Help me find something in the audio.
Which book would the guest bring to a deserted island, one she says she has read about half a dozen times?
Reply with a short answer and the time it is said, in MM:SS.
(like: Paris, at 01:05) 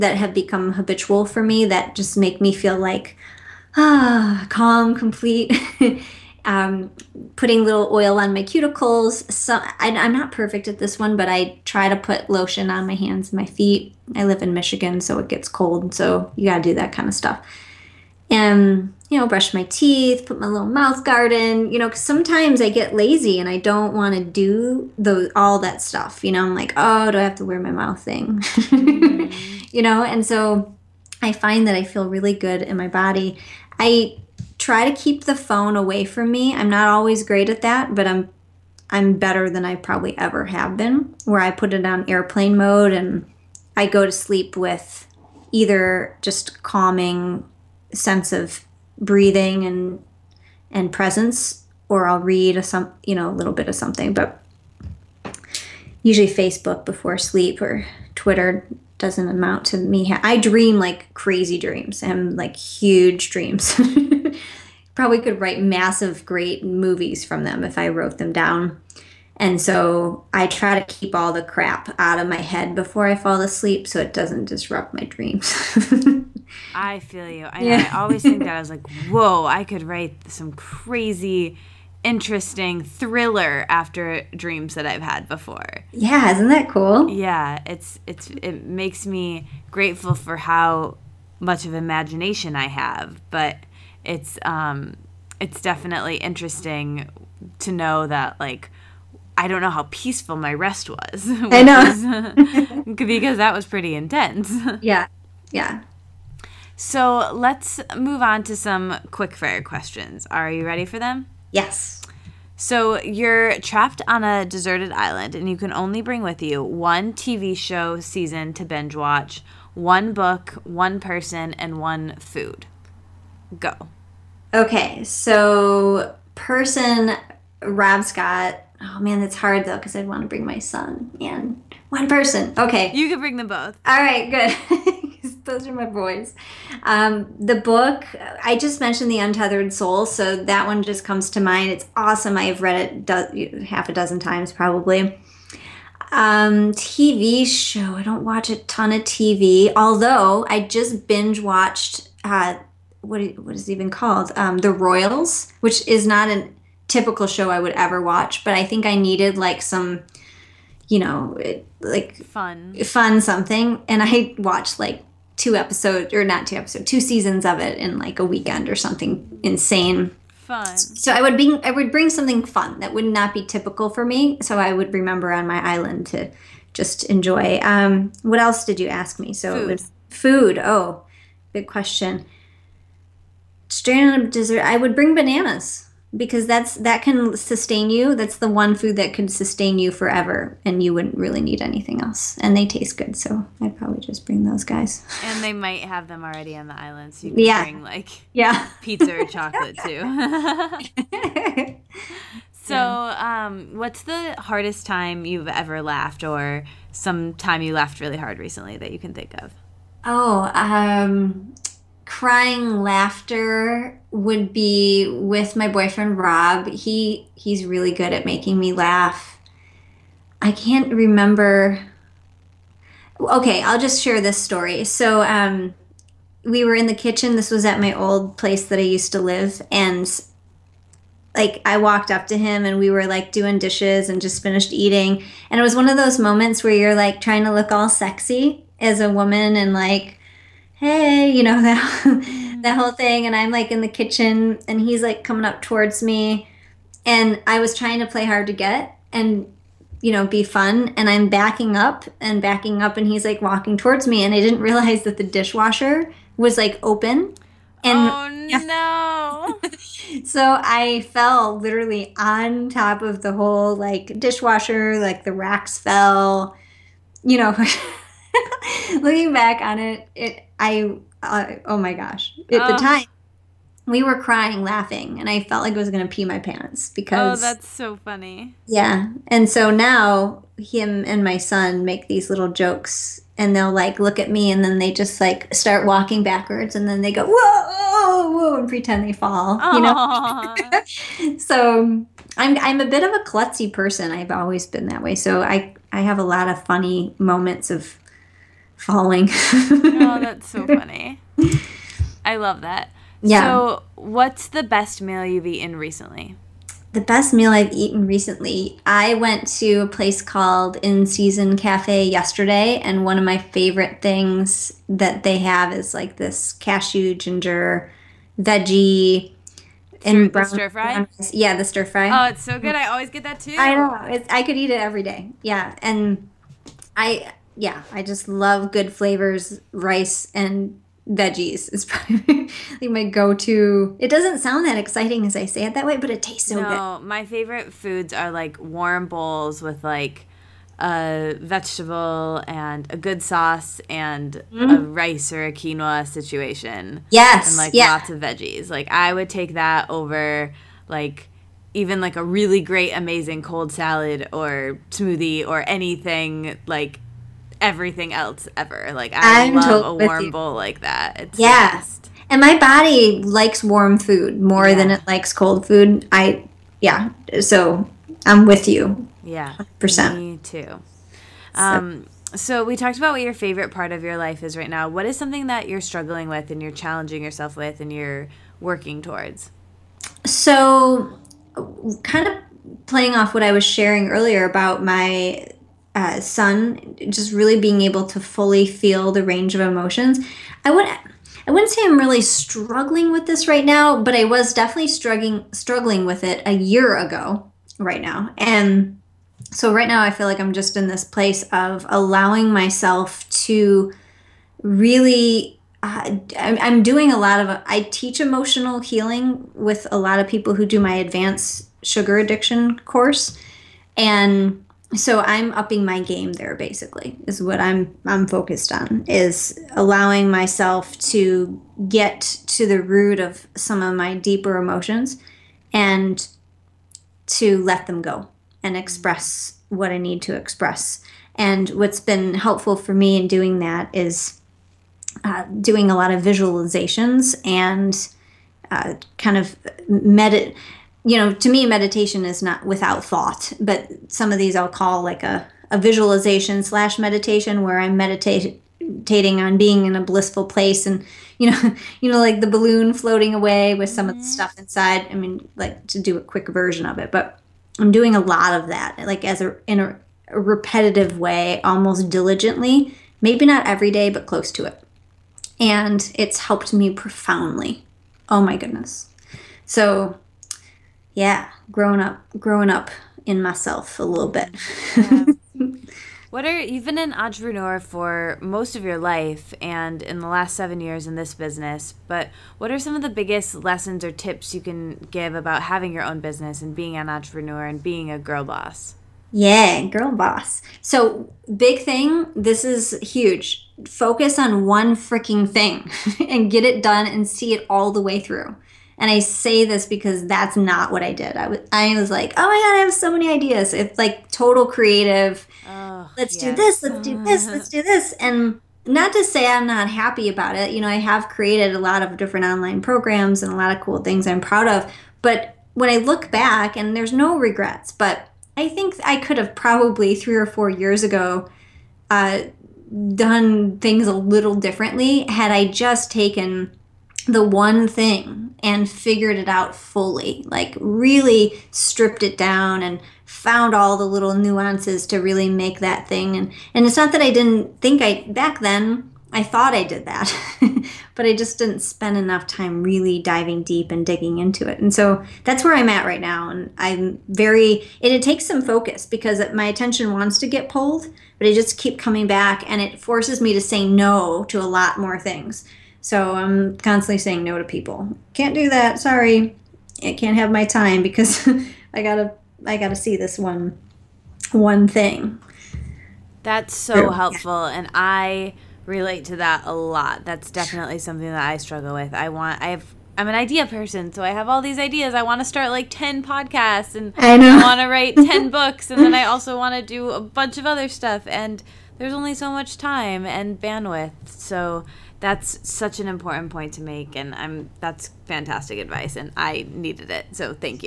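The Untethered Soul, at 02:19.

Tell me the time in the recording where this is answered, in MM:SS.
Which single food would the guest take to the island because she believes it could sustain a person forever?
03:05.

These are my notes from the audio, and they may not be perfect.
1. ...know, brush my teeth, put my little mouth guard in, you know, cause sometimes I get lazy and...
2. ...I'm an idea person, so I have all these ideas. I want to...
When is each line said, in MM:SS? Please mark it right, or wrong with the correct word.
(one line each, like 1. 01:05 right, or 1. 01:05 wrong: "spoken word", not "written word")
1. 00:19 right
2. 09:33 right.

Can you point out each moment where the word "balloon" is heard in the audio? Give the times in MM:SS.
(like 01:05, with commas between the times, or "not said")
07:32.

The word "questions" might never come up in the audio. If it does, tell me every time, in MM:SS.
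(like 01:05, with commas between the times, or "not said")
01:49, 03:01.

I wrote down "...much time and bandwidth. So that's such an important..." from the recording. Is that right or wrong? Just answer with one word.
right.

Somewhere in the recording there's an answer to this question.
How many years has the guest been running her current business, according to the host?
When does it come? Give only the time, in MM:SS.
08:00.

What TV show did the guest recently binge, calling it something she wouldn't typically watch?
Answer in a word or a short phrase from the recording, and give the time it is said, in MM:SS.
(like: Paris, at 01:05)
The Royals, at 02:34.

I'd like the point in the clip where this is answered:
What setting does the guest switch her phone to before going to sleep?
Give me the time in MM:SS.
00:42.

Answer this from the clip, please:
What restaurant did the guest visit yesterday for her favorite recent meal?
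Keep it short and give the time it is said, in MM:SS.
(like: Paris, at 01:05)
In Season Cafe, at 05:10.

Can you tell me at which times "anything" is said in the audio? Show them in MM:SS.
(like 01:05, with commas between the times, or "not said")
03:11, 05:55.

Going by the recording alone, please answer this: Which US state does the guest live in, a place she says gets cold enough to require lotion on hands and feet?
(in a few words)
Michigan.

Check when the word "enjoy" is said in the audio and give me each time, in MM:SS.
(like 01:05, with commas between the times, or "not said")
02:57.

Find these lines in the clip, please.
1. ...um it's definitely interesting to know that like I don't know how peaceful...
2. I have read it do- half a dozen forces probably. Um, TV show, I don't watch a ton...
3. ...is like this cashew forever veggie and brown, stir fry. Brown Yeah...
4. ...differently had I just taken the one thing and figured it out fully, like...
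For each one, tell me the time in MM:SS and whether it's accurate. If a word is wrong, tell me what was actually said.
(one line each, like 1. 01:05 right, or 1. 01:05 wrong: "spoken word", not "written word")
1. 01:34 right
2. 02:22 wrong: "times", not "forces"
3. 05:15 wrong: "ginger", not "forever"
4. 08:44 right.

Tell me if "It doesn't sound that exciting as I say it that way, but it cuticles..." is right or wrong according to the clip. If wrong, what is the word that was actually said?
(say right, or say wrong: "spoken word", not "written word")
wrong: "tastes", not "cuticles".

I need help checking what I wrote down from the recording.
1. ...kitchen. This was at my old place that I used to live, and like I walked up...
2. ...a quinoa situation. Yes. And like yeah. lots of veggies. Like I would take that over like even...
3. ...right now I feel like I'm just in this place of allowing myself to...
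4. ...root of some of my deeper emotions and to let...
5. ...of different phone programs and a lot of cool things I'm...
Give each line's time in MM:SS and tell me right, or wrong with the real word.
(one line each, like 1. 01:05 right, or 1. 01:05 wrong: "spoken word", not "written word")
1. 03:46 right
2. 05:45 right
3. 06:39 right
4. 07:02 right
5. 08:32 wrong: "online", not "phone".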